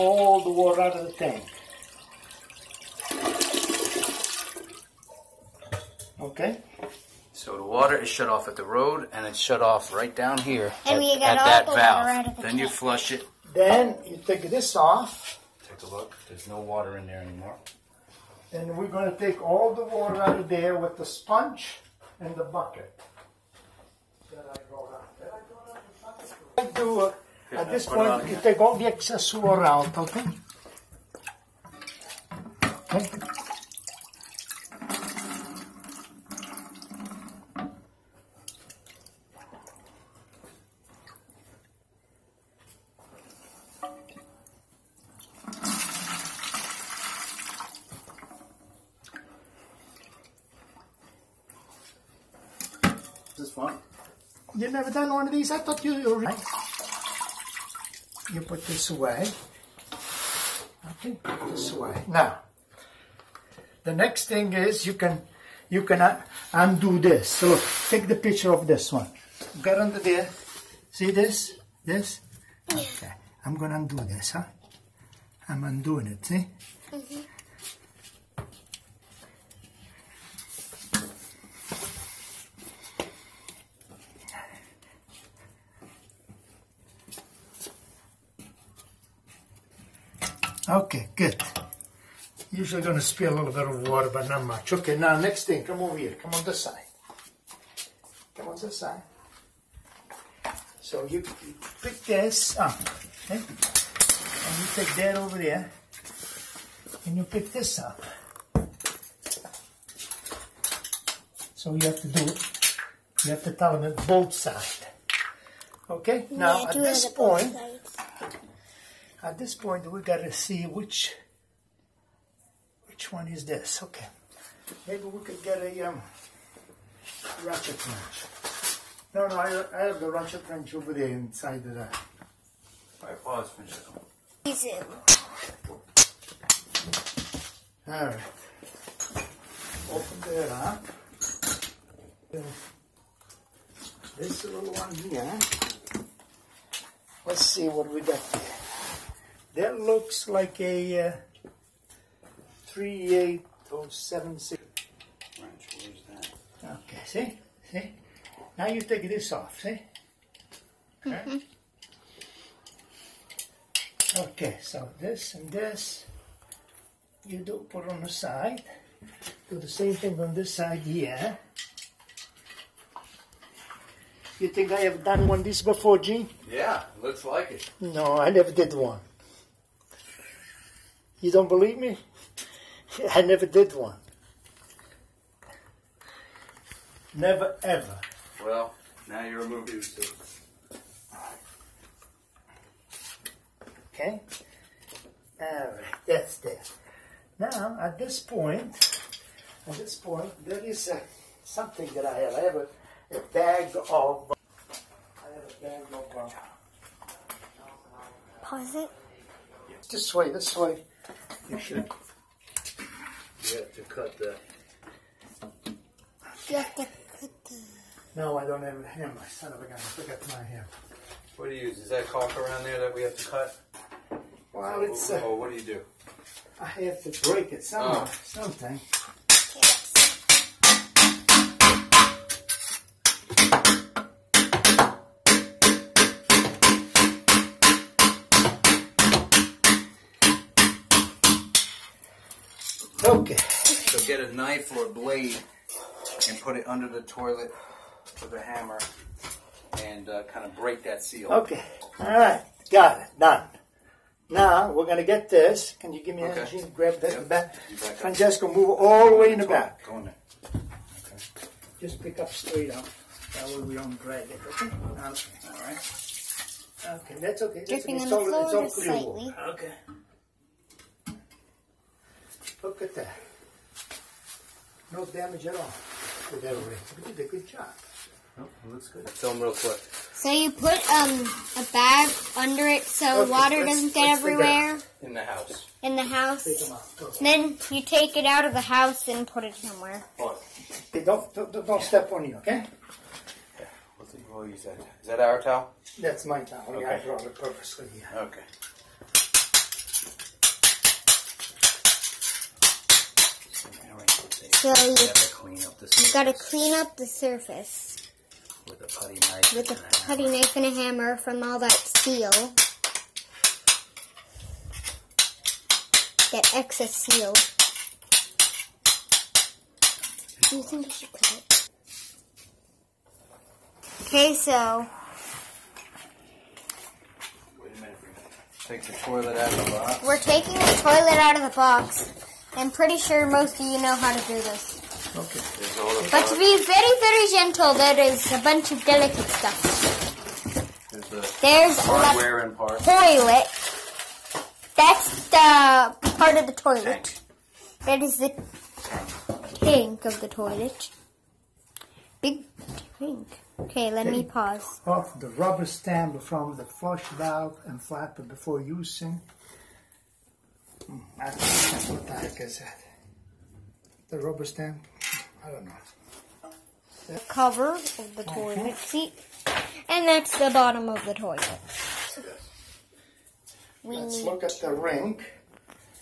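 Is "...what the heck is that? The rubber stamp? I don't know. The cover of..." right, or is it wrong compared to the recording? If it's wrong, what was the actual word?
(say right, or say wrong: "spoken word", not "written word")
right.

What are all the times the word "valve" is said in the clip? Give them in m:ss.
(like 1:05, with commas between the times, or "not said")
0:11, 5:57.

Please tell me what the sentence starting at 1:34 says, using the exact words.
Okay, now next thing, come over here.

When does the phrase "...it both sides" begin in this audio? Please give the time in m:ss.
1:53.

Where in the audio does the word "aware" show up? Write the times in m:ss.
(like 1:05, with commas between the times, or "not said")
not said.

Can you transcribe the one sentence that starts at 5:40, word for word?
There's, the There's hardware and parts.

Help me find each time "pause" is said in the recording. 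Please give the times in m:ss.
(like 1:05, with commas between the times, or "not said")
2:13, 3:28, 5:54.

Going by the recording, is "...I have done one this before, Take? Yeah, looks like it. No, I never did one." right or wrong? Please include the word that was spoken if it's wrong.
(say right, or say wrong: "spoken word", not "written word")
wrong: "Gene", not "Take".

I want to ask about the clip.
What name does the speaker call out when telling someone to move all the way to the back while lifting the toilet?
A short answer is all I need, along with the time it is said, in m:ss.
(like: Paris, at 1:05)
Francesco, at 4:17.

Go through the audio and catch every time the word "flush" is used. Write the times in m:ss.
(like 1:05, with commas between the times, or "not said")
0:12, 5:56.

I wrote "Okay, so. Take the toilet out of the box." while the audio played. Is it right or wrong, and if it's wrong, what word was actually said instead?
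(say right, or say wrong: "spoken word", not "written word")
right.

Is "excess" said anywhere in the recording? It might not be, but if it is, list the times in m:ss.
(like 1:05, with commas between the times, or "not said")
0:28, 5:16.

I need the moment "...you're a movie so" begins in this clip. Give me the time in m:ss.
3:09.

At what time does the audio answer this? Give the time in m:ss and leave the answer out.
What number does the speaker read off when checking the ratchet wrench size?
2:32.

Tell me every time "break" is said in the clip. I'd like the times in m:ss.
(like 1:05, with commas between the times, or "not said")
3:47, 4:10.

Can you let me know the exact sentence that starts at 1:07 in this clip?
So look, take the picture of this one.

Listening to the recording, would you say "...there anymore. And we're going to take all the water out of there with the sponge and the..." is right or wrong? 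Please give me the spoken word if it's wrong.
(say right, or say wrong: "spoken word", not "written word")
right.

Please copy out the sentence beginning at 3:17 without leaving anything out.
Now, at this point, at this point, there is uh, something that I have.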